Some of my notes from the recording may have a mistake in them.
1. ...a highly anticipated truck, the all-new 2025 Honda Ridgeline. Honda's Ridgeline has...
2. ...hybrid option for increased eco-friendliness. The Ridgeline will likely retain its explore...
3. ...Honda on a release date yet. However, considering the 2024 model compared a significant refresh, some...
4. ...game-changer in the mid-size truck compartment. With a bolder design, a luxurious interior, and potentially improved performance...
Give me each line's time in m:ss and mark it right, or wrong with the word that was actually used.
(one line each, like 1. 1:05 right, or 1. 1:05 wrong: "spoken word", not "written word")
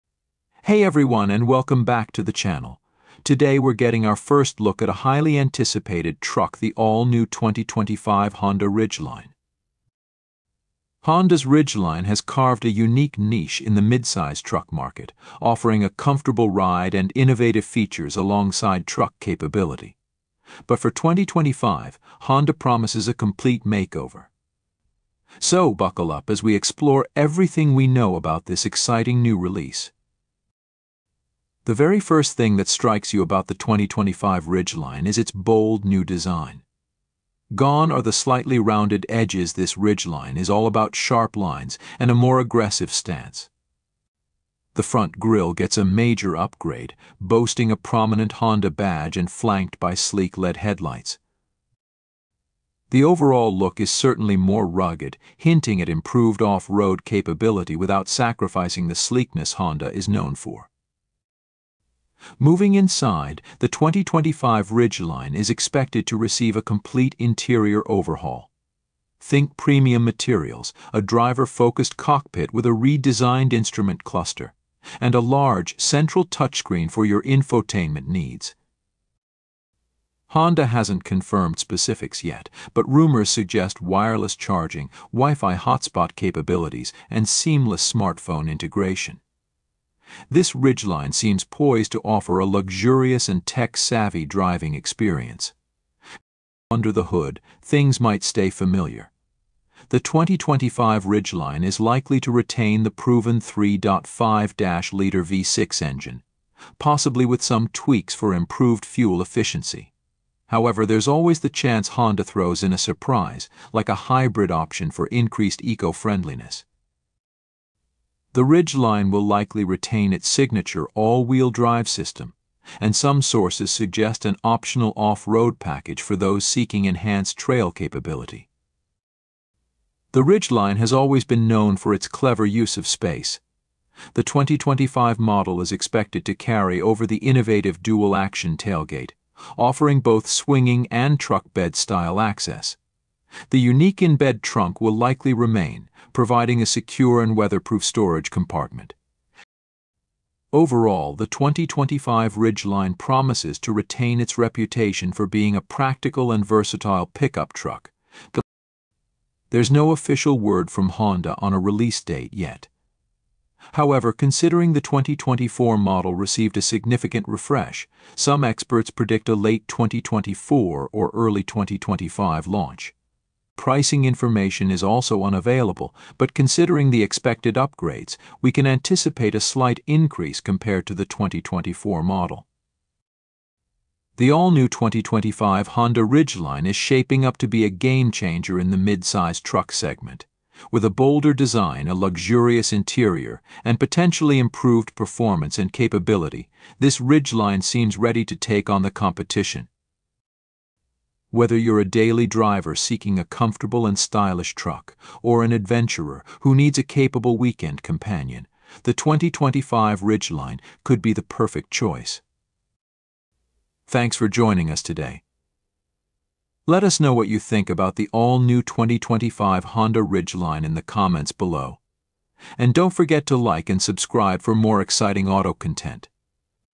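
1. 0:04 right
2. 1:54 wrong: "signature", not "explore"
3. 2:40 wrong: "received", not "compared"
4. 3:07 wrong: "segment", not "compartment".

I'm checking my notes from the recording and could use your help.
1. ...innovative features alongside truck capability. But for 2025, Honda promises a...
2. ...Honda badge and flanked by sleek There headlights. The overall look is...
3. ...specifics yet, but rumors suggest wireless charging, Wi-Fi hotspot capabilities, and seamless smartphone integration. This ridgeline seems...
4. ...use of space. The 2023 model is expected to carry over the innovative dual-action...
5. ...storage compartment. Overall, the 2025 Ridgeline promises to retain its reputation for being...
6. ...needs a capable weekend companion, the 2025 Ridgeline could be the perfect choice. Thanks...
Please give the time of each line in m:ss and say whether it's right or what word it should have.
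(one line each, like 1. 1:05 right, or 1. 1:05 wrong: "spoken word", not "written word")
1. 0:17 right
2. 0:48 wrong: "LED", not "There"
3. 1:21 right
4. 2:12 wrong: "2025", not "2023"
5. 2:27 right
6. 3:26 right.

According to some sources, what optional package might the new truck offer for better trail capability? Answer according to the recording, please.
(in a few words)
off-road package.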